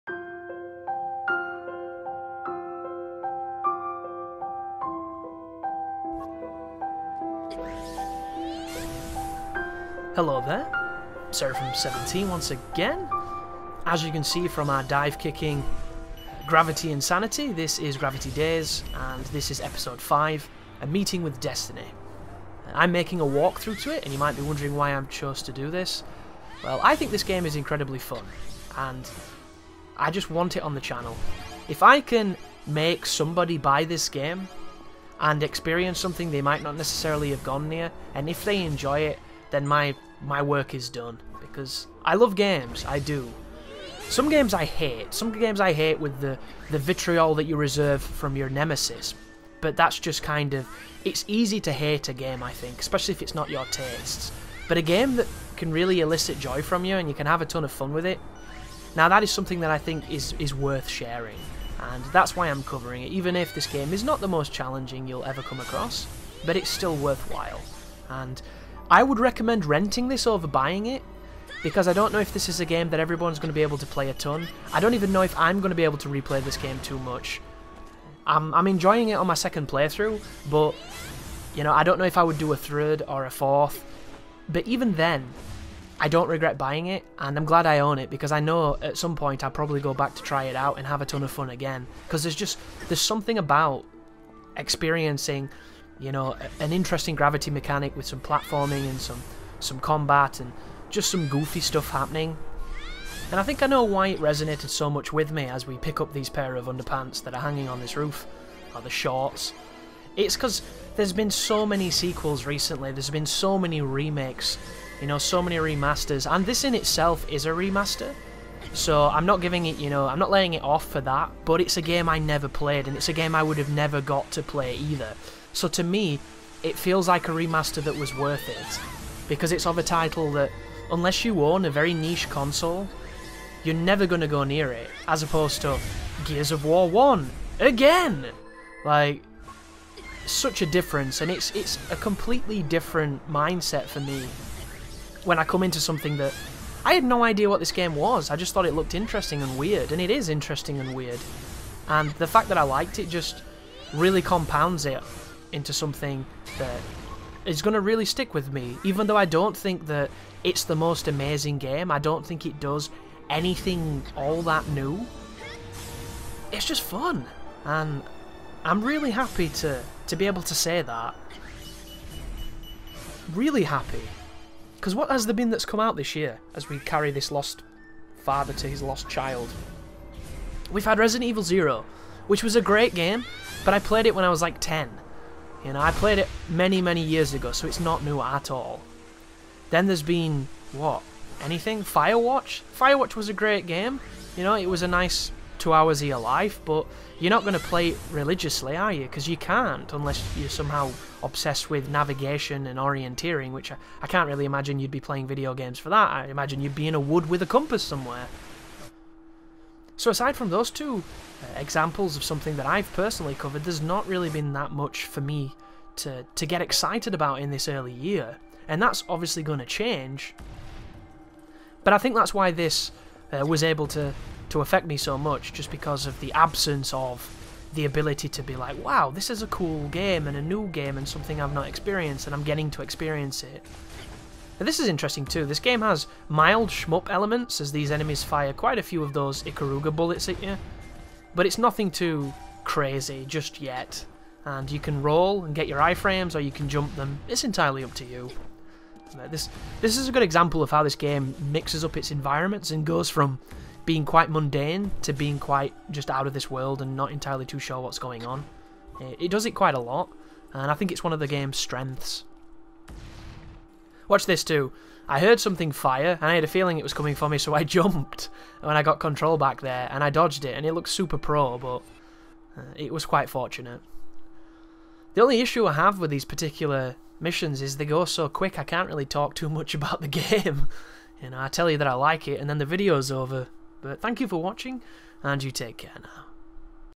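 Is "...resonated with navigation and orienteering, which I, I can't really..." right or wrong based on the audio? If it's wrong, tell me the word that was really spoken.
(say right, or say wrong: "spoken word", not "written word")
wrong: "obsessed", not "resonated".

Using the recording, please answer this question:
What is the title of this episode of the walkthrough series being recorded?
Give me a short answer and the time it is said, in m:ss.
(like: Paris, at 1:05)
A Meeting with Destiny, at 0:20.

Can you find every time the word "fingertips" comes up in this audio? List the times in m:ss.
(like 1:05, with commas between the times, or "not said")
not said.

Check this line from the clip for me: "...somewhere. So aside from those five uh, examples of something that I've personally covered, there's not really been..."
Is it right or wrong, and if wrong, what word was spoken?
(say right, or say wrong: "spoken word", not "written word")
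wrong: "two", not "five".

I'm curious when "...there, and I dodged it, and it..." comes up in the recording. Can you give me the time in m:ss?
4:29.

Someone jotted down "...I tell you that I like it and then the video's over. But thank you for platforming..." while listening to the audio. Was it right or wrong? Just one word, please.
wrong.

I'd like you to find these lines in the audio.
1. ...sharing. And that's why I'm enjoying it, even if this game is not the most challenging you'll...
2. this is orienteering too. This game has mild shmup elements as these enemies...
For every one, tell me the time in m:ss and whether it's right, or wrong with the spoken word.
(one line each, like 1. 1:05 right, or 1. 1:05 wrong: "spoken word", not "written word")
1. 1:00 wrong: "covering", not "enjoying"
2. 3:54 wrong: "interesting", not "orienteering".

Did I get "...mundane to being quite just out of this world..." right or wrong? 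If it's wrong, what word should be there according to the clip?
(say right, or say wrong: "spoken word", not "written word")
right.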